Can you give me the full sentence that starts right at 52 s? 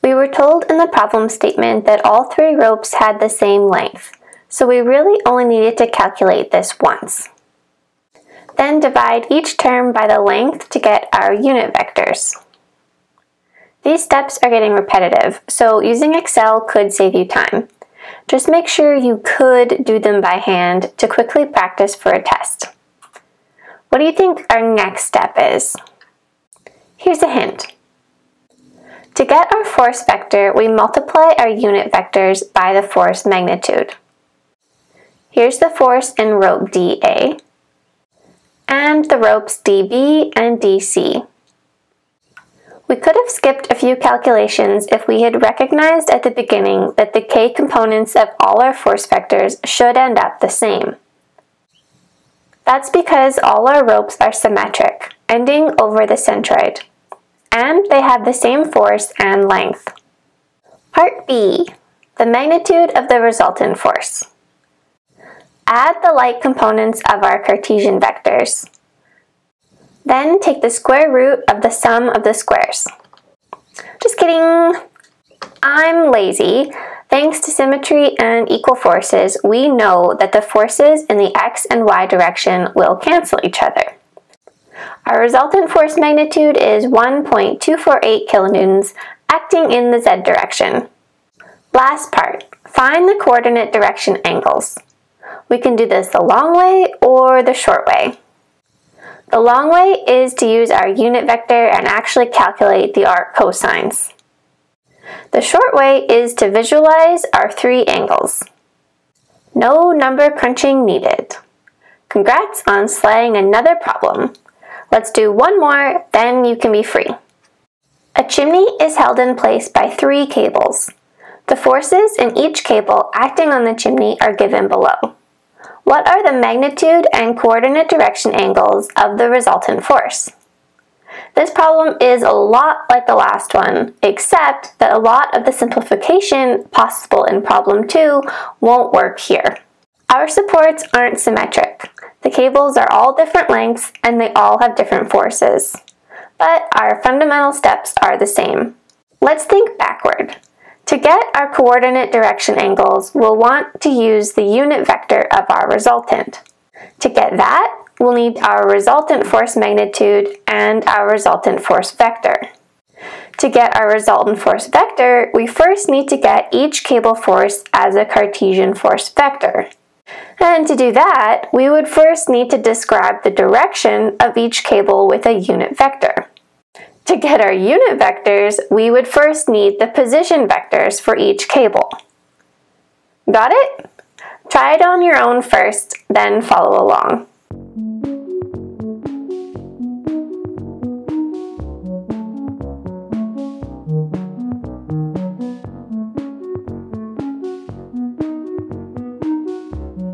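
That's because all our ropes are symmetric, ending over the centroid and they have the same force and length.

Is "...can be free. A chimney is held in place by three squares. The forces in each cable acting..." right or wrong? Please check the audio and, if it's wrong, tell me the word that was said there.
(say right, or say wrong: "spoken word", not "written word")
wrong: "cables", not "squares".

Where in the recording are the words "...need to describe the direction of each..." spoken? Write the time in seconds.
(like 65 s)
172 s.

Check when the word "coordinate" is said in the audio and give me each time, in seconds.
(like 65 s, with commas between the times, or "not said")
93 s, 127 s, 151 s.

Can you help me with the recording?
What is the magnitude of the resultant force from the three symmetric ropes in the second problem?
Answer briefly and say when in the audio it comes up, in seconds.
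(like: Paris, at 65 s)
1.248 kilonewtons, at 86 s.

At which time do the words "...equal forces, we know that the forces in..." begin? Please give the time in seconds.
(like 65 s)
78 s.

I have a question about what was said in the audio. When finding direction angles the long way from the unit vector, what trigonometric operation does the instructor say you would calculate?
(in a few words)
Arc cosines.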